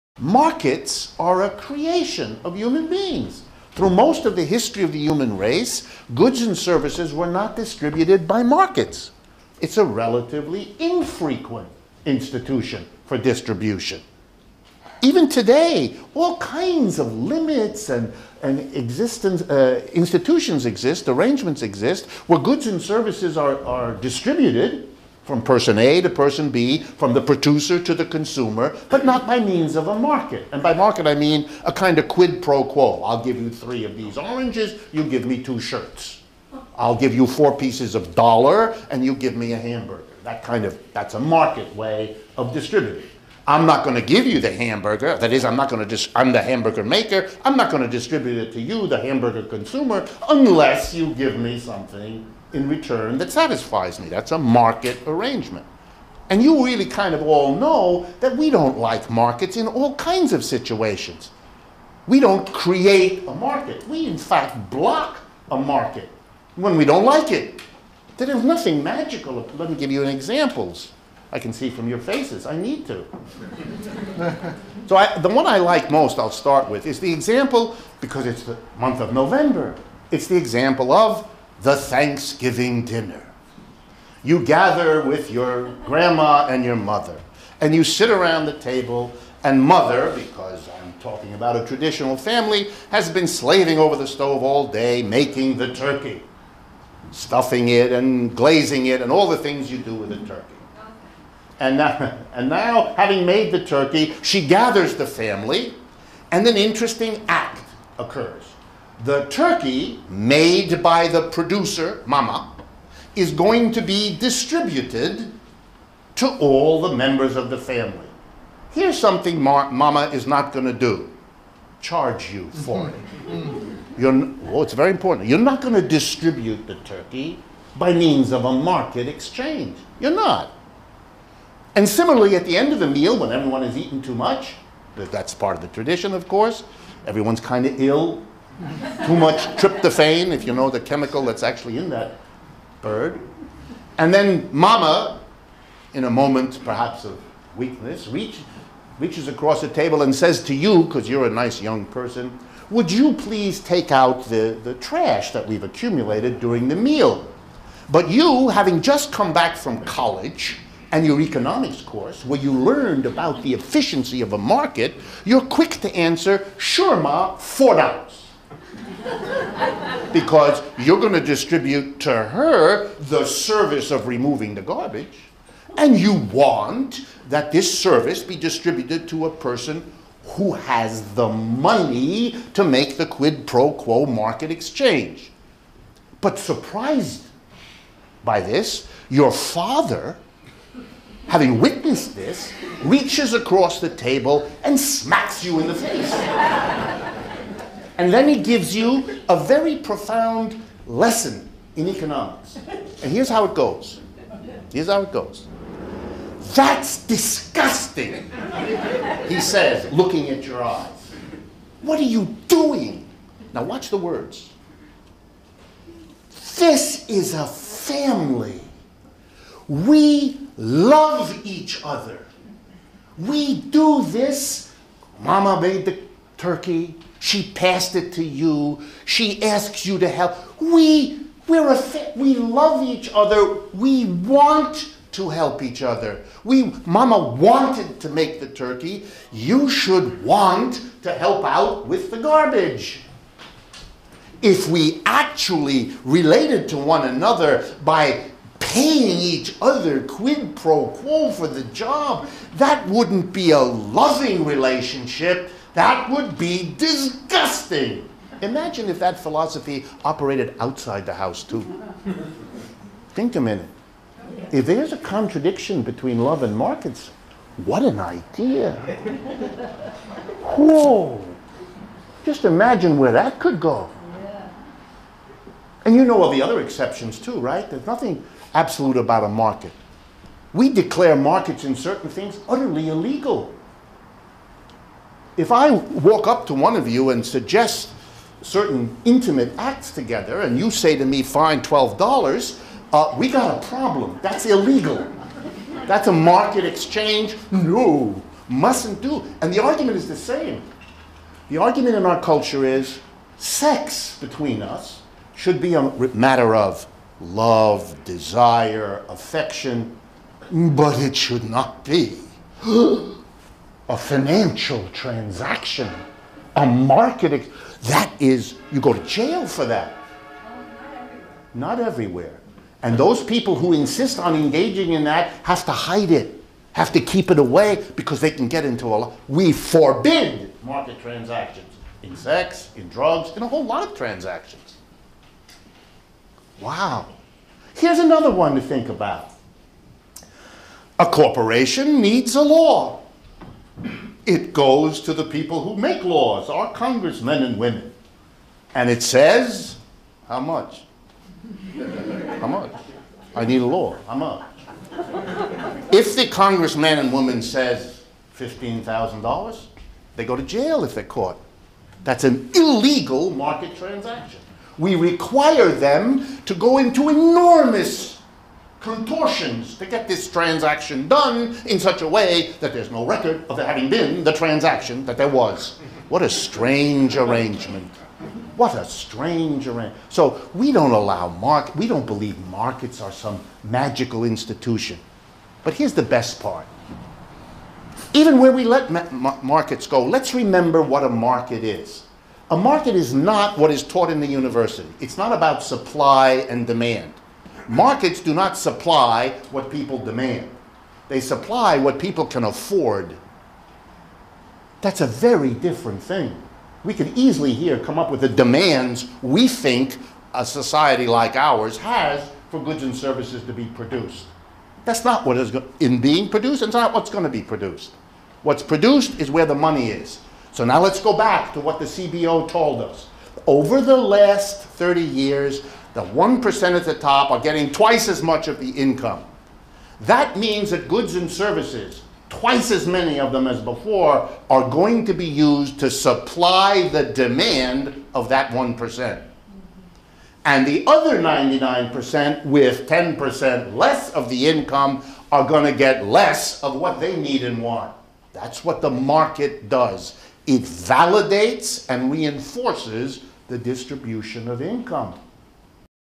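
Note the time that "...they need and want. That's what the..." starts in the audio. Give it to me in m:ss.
7:26.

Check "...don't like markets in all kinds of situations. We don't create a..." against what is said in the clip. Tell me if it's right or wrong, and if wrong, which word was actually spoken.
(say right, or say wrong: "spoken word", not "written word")
right.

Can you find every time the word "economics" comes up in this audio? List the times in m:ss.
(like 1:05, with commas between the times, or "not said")
2:41, 3:21.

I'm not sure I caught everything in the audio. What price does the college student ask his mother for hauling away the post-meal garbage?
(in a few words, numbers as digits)
$4.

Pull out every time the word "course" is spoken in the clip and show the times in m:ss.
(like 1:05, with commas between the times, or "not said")
2:16, 2:41.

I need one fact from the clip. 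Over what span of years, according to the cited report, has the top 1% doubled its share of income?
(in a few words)
30 years.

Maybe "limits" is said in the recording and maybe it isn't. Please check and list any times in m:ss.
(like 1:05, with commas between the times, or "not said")
0:17.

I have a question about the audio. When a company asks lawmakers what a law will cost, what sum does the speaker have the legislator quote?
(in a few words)
$15,000.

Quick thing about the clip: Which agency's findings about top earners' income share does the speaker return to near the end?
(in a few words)
CBO.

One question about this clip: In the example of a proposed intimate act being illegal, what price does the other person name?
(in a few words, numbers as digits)
$12.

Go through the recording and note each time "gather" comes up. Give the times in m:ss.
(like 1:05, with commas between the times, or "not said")
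1:24, 1:44.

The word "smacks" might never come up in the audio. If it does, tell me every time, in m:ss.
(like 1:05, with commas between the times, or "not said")
3:14.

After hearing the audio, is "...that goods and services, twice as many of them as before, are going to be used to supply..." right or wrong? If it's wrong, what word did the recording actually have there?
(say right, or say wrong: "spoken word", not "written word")
right.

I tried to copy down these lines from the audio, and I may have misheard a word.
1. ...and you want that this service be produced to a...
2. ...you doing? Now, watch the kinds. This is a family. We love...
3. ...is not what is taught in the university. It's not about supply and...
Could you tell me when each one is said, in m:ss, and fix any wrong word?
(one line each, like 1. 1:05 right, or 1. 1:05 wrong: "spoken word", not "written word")
1. 2:55 wrong: "distributed", not "produced"
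2. 3:32 wrong: "words", not "kinds"
3. 6:32 right.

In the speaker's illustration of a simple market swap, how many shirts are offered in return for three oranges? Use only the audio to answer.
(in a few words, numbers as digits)
2.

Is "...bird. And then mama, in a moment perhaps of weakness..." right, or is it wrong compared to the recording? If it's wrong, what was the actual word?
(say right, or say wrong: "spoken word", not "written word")
right.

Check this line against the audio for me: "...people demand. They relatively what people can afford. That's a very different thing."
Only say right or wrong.
wrong.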